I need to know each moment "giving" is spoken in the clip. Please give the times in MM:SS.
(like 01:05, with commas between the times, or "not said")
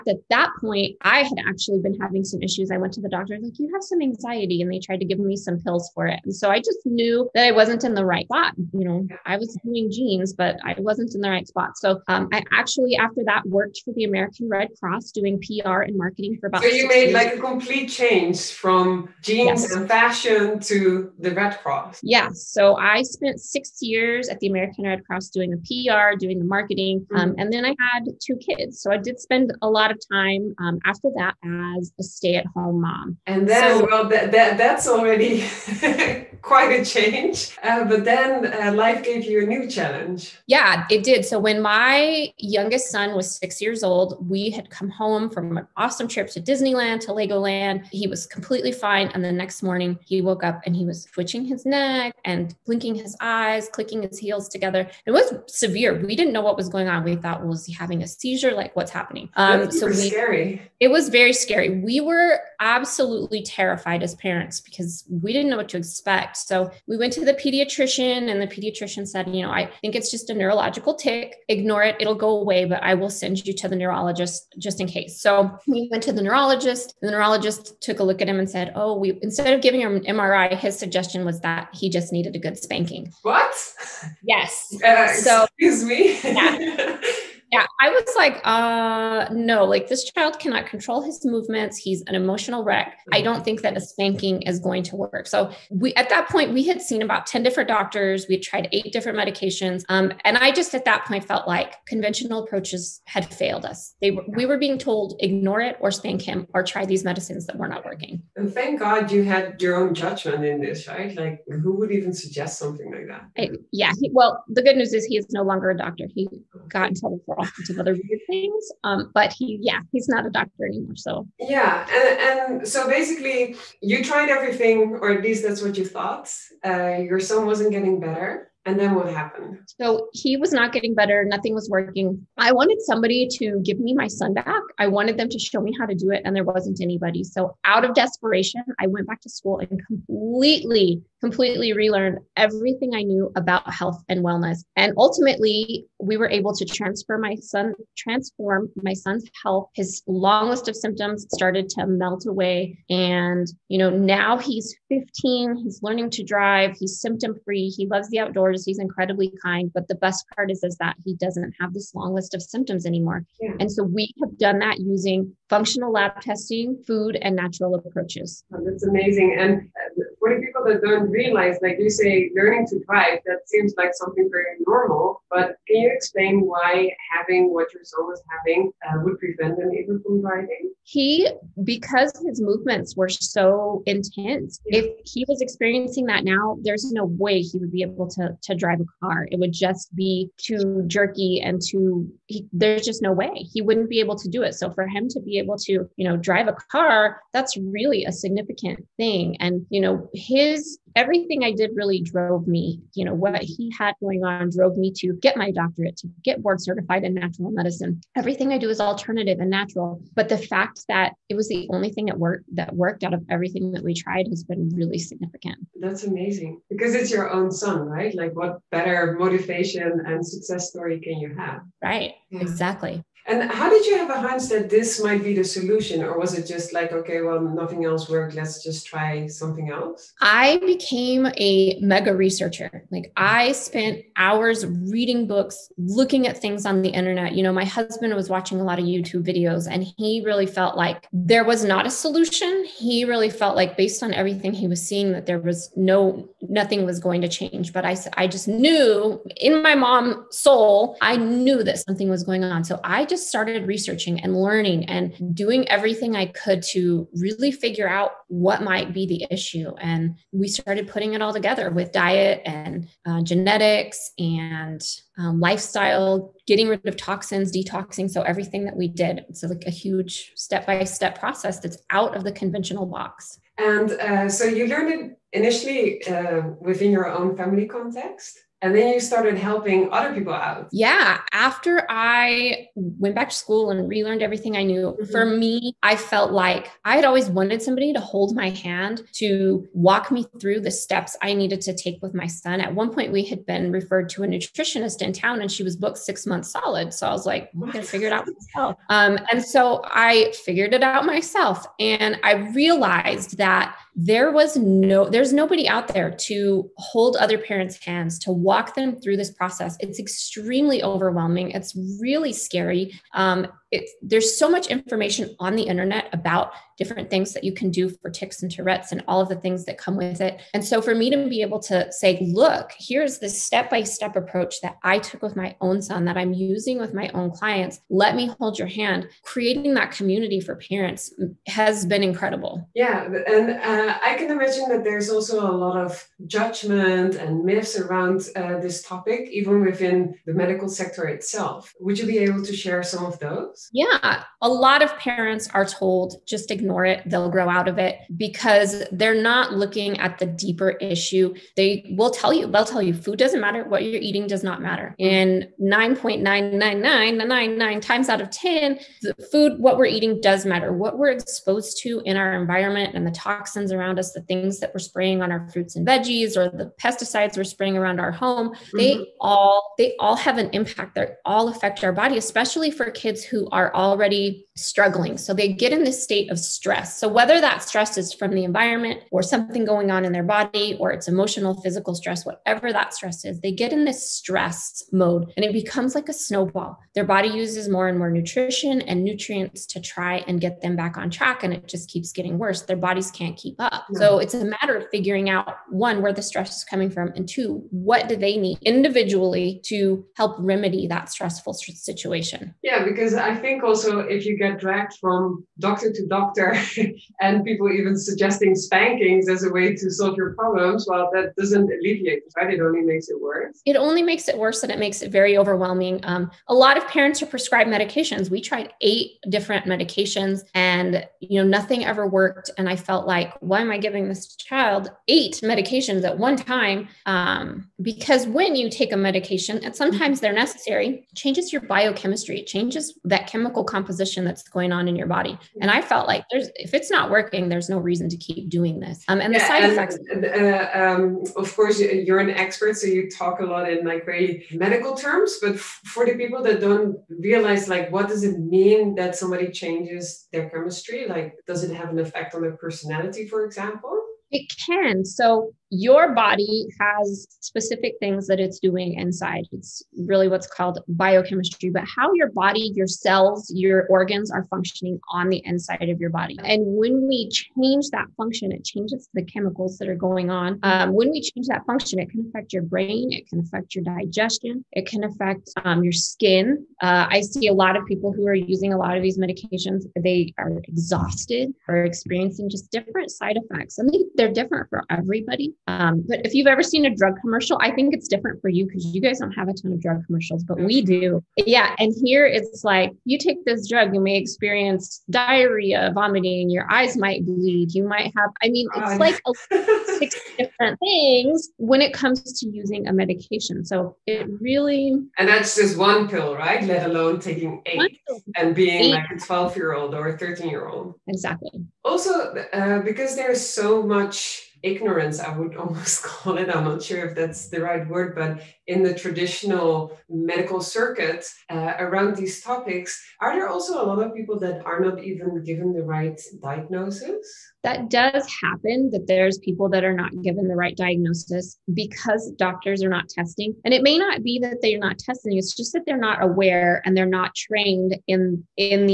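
01:19, 07:03.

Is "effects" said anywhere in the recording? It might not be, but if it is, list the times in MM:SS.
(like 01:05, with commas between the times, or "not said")
07:19, 07:31, 08:03.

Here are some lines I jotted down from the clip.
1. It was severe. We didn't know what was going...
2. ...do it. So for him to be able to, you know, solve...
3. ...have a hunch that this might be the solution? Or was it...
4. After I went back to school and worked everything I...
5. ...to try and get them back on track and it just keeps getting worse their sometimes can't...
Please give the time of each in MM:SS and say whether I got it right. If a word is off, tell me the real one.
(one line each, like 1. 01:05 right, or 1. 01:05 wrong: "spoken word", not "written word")
1. 00:55 right
2. 03:14 wrong: "drive", not "solve"
3. 03:43 right
4. 04:41 wrong: "relearned", not "worked"
5. 06:29 wrong: "bodies", not "sometimes".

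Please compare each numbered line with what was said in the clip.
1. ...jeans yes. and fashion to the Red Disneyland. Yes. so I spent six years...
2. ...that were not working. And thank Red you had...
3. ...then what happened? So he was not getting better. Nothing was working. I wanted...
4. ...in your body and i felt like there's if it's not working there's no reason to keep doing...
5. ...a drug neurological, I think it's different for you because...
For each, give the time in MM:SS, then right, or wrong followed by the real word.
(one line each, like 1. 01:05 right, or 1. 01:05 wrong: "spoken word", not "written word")
1. 00:19 wrong: "Cross", not "Disneyland"
2. 01:47 wrong: "God", not "Red"
3. 02:08 right
4. 07:14 right
5. 08:06 wrong: "commercial", not "neurological".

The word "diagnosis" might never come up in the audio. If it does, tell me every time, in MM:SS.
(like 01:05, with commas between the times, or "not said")
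08:46, 08:50.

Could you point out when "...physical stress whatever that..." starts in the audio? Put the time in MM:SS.
06:21.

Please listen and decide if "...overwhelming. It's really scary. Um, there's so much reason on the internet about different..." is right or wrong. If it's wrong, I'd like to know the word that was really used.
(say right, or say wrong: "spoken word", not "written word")
wrong: "information", not "reason".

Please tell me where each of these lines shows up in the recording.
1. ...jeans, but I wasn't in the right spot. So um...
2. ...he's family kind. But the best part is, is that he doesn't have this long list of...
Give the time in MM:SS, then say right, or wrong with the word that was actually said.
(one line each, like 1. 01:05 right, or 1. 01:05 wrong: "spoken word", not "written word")
1. 00:09 right
2. 02:38 wrong: "incredibly", not "family".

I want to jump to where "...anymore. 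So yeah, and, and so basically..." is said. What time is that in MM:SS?
02:00.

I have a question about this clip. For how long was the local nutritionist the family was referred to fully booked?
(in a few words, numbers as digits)
6 months.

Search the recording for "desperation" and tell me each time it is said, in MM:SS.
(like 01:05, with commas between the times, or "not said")
02:17.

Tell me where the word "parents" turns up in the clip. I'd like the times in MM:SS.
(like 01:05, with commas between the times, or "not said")
01:04, 05:07, 05:30, 05:44, 06:56.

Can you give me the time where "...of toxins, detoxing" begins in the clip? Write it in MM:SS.
04:26.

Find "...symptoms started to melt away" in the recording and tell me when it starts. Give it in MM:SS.
02:30.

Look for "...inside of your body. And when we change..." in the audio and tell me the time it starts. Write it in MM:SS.
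07:45.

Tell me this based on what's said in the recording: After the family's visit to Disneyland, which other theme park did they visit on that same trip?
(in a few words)
Legoland.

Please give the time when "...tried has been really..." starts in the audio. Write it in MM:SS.
03:33.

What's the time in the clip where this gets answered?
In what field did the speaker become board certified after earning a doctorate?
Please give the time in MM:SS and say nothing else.
03:27.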